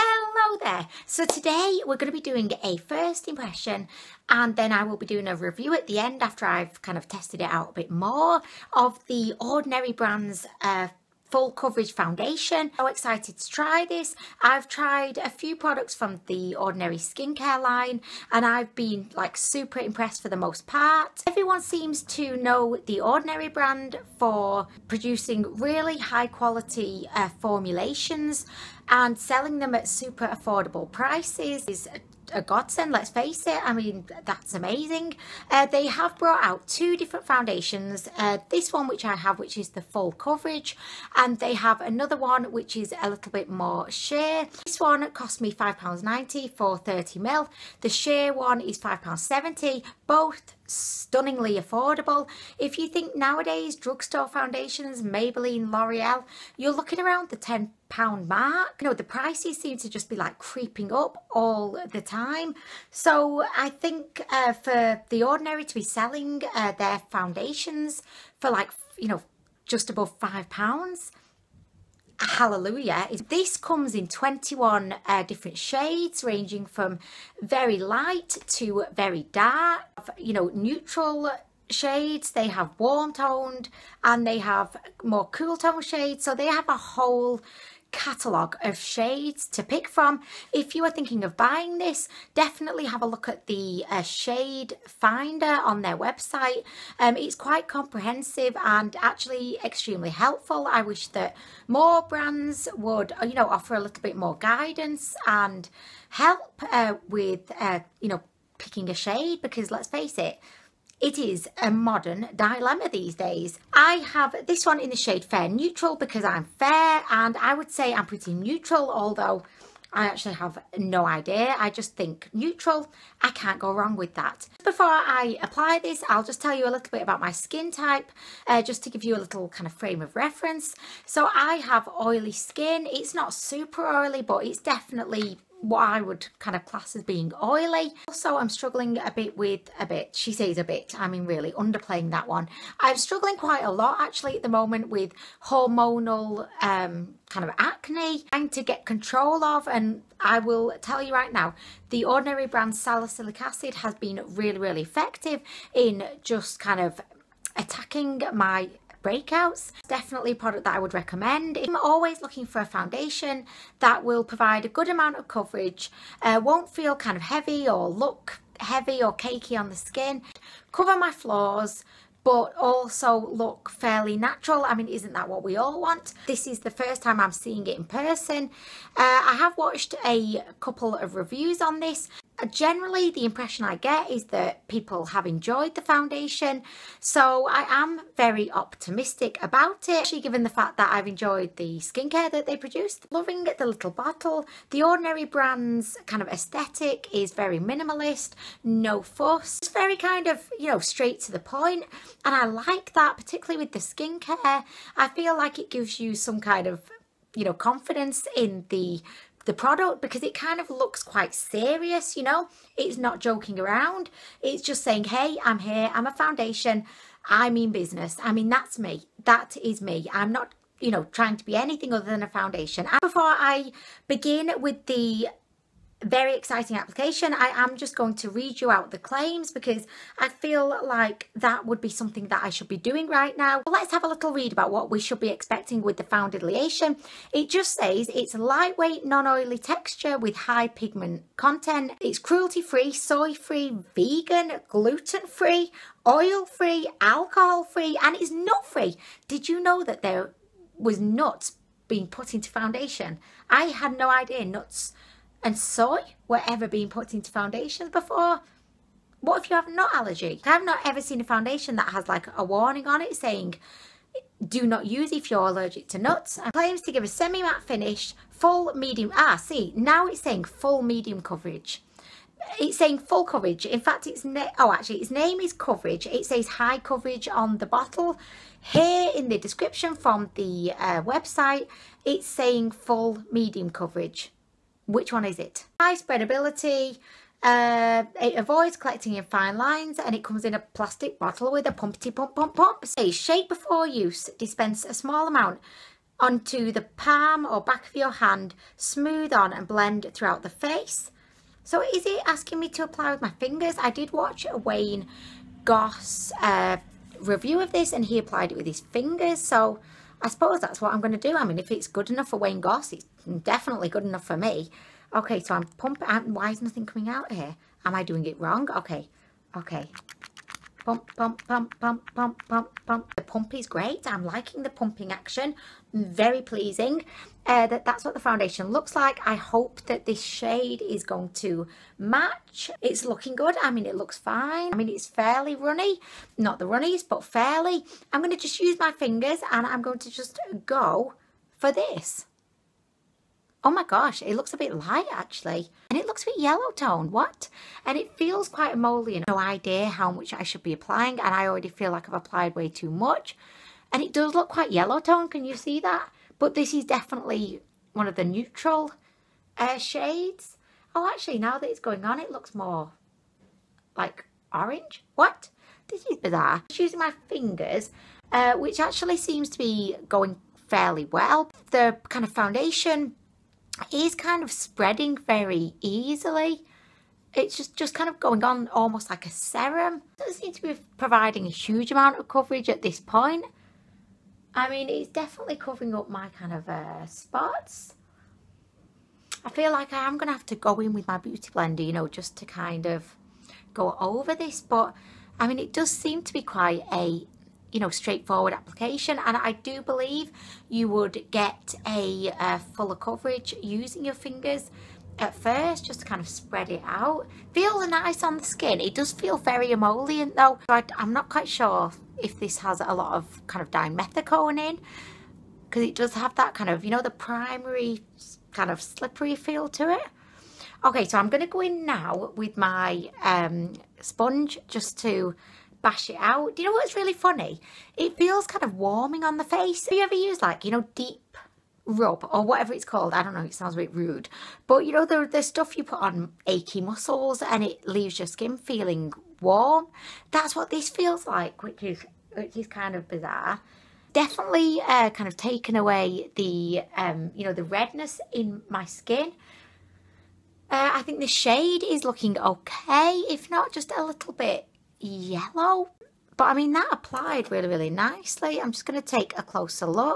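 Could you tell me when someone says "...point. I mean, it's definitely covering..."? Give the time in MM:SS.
06:22.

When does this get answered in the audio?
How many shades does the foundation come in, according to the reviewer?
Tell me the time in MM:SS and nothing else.
01:14.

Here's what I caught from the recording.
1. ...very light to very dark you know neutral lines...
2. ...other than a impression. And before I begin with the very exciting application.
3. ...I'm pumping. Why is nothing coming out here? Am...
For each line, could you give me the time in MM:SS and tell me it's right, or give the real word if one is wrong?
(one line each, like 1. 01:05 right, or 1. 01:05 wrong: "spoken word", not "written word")
1. 01:17 wrong: "shades", not "lines"
2. 03:41 wrong: "foundation", not "impression"
3. 05:15 right.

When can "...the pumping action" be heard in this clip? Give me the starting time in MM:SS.
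05:24.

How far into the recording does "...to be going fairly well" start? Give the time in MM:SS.
06:09.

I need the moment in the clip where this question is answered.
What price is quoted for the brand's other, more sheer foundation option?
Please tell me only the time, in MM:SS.
00:48.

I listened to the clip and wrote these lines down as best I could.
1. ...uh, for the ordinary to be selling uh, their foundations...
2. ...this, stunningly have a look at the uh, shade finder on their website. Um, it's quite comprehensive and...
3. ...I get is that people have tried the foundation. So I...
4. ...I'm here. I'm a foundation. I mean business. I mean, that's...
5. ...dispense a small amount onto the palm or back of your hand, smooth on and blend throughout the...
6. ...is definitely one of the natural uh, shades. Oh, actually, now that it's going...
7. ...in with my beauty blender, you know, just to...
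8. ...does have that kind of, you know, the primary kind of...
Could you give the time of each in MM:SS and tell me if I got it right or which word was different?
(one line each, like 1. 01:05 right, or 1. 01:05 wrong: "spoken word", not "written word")
1. 01:04 right
2. 01:31 wrong: "definitely", not "stunningly"
3. 03:03 wrong: "enjoyed", not "tried"
4. 03:35 right
5. 04:54 right
6. 05:56 wrong: "neutral", not "natural"
7. 06:30 right
8. 06:55 right.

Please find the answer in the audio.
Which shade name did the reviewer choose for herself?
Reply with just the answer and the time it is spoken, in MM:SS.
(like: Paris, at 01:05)
Fair Neutral, at 01:55.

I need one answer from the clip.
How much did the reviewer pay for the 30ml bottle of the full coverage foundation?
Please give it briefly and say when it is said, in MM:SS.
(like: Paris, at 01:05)
£5.90, at 00:45.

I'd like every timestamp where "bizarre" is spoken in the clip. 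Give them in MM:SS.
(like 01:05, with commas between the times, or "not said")
06:06, 07:23.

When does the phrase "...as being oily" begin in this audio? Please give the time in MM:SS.
02:16.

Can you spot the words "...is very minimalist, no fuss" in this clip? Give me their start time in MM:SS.
03:17.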